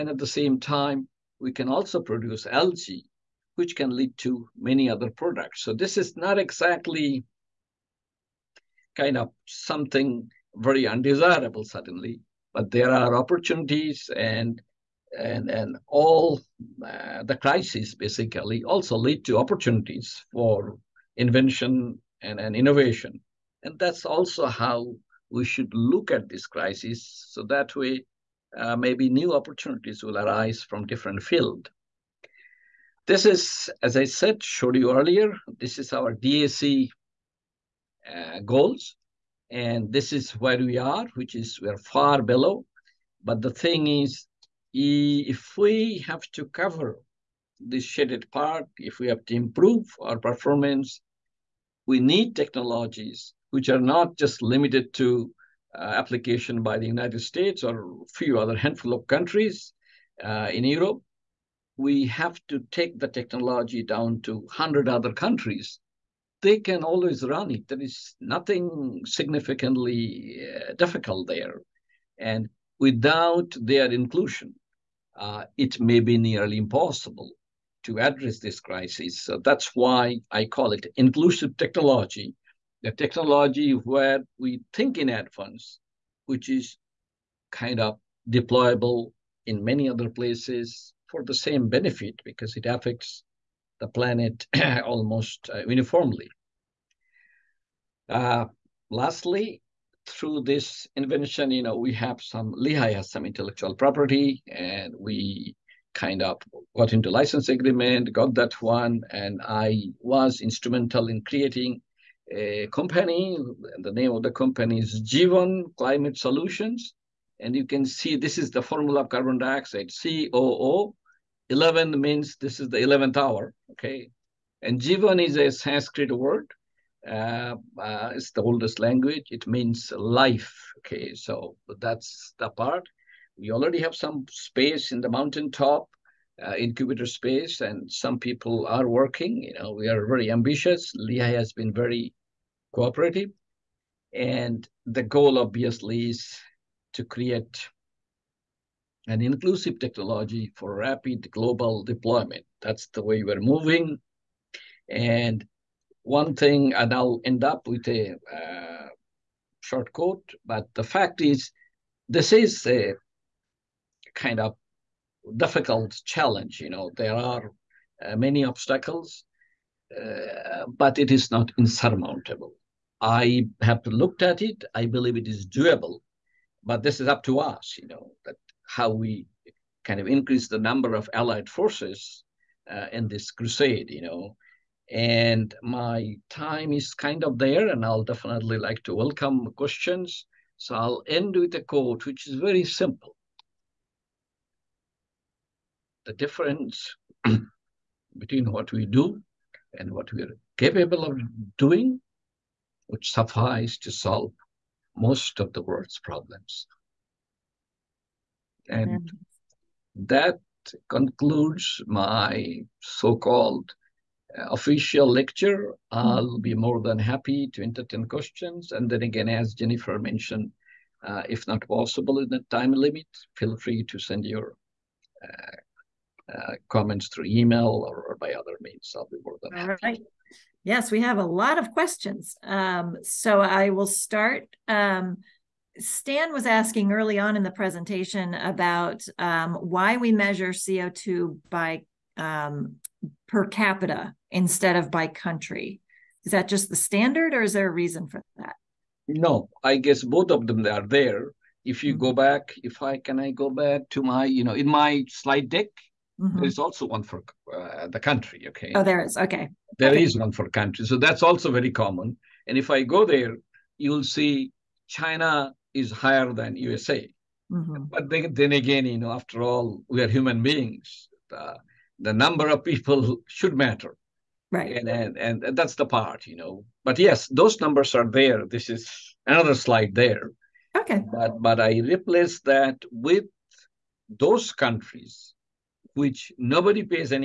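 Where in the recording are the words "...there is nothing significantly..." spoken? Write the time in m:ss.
1:07.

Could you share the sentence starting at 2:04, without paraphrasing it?
And Jivan is a Sanskrit word.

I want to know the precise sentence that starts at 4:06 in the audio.
Is that just the standard or is there a reason for that?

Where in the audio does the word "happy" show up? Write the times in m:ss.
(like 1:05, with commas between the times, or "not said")
3:36, 3:49.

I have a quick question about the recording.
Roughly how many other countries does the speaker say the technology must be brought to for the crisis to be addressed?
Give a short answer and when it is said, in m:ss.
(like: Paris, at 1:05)
100, at 1:04.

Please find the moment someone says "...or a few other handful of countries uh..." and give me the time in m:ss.
0:57.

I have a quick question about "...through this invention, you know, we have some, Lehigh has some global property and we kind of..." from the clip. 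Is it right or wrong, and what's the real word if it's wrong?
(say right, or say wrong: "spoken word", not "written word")
wrong: "intellectual", not "global".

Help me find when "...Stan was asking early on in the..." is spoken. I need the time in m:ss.
3:55.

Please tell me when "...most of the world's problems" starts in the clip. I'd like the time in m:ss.
3:24.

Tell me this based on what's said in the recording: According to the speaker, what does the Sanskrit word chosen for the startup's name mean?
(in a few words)
Life.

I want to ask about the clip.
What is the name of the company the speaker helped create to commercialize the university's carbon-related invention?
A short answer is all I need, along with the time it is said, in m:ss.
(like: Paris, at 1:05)
Jivan Climate Solutions, at 1:55.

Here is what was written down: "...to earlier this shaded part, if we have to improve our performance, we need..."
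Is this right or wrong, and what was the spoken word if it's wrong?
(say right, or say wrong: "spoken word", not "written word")
wrong: "cover", not "earlier".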